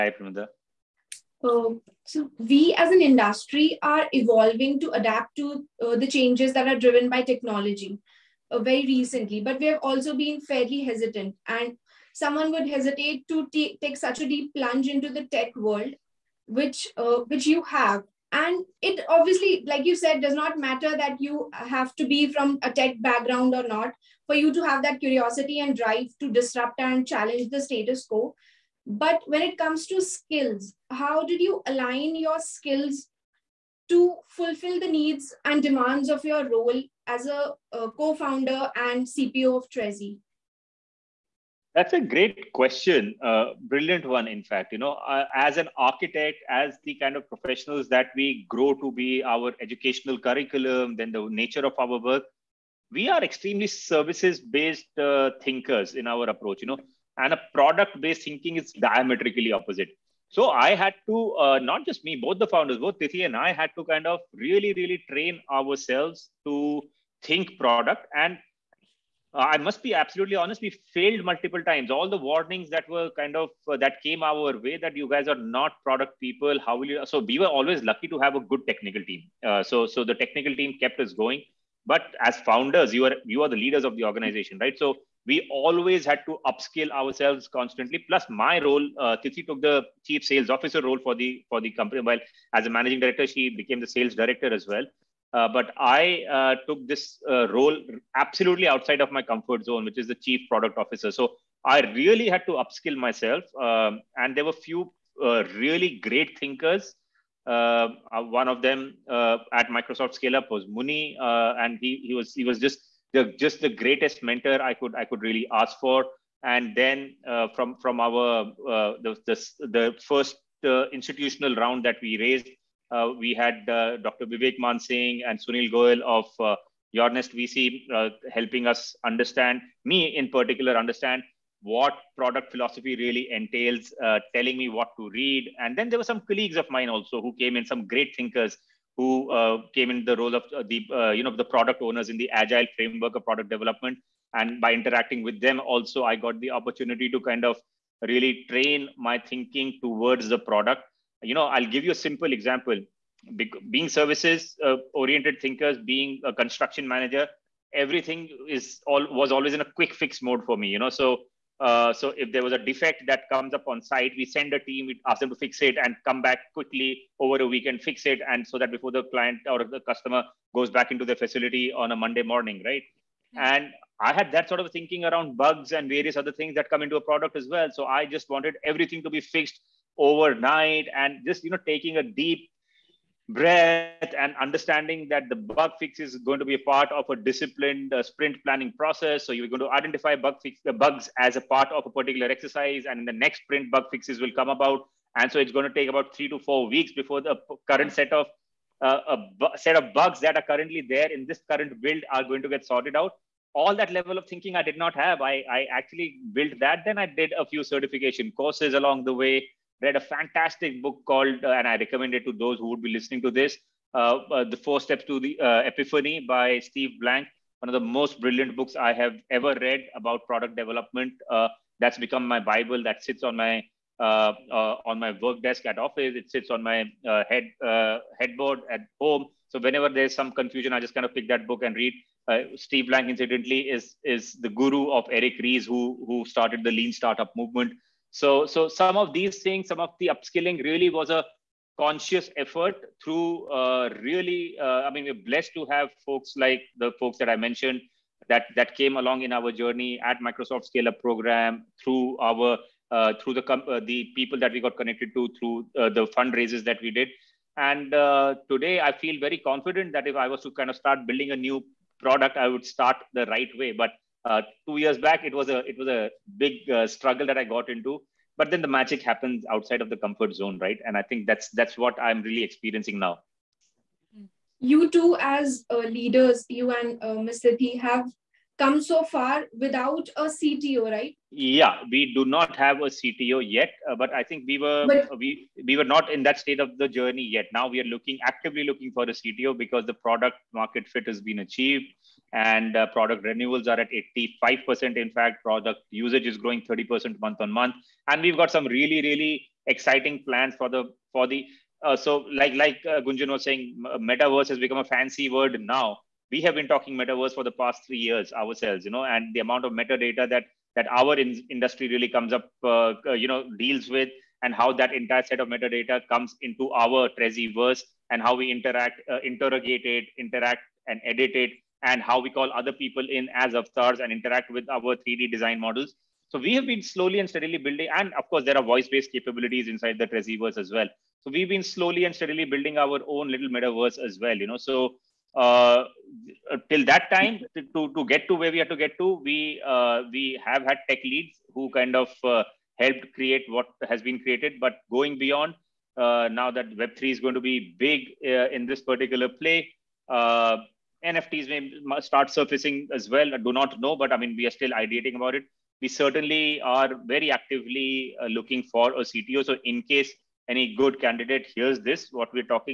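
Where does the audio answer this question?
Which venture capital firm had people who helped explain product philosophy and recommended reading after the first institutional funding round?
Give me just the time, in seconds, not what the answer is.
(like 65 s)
126 s.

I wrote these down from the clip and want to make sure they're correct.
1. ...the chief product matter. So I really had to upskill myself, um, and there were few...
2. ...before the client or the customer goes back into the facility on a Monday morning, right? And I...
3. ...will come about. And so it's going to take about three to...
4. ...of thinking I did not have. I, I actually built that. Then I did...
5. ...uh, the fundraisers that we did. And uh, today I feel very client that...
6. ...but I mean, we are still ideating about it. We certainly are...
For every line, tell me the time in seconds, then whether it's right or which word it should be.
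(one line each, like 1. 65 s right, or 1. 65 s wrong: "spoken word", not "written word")
1. 100 s wrong: "officer", not "matter"
2. 168 s right
3. 194 s right
4. 204 s right
5. 255 s wrong: "confident", not "client"
6. 353 s right.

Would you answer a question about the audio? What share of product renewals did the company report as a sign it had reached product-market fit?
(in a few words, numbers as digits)
85%.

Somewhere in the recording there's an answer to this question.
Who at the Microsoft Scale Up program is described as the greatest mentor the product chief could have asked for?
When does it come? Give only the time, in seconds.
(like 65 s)
110 s.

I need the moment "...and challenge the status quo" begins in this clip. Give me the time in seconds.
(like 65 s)
26 s.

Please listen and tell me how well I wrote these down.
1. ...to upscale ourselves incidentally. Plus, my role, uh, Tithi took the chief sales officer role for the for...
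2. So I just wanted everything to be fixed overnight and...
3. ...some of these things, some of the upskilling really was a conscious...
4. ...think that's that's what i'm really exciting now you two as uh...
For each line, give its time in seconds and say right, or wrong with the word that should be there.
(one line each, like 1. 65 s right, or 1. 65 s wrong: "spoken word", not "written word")
1. 86 s wrong: "constantly", not "incidentally"
2. 177 s right
3. 238 s right
4. 271 s wrong: "experiencing", not "exciting".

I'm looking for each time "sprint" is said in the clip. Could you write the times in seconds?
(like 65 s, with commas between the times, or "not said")
188 s, 193 s.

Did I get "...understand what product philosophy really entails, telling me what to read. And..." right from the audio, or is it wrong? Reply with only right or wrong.
right.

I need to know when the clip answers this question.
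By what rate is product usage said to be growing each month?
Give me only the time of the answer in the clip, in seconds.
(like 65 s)
296 s.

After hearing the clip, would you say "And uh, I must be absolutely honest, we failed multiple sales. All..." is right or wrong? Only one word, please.
wrong.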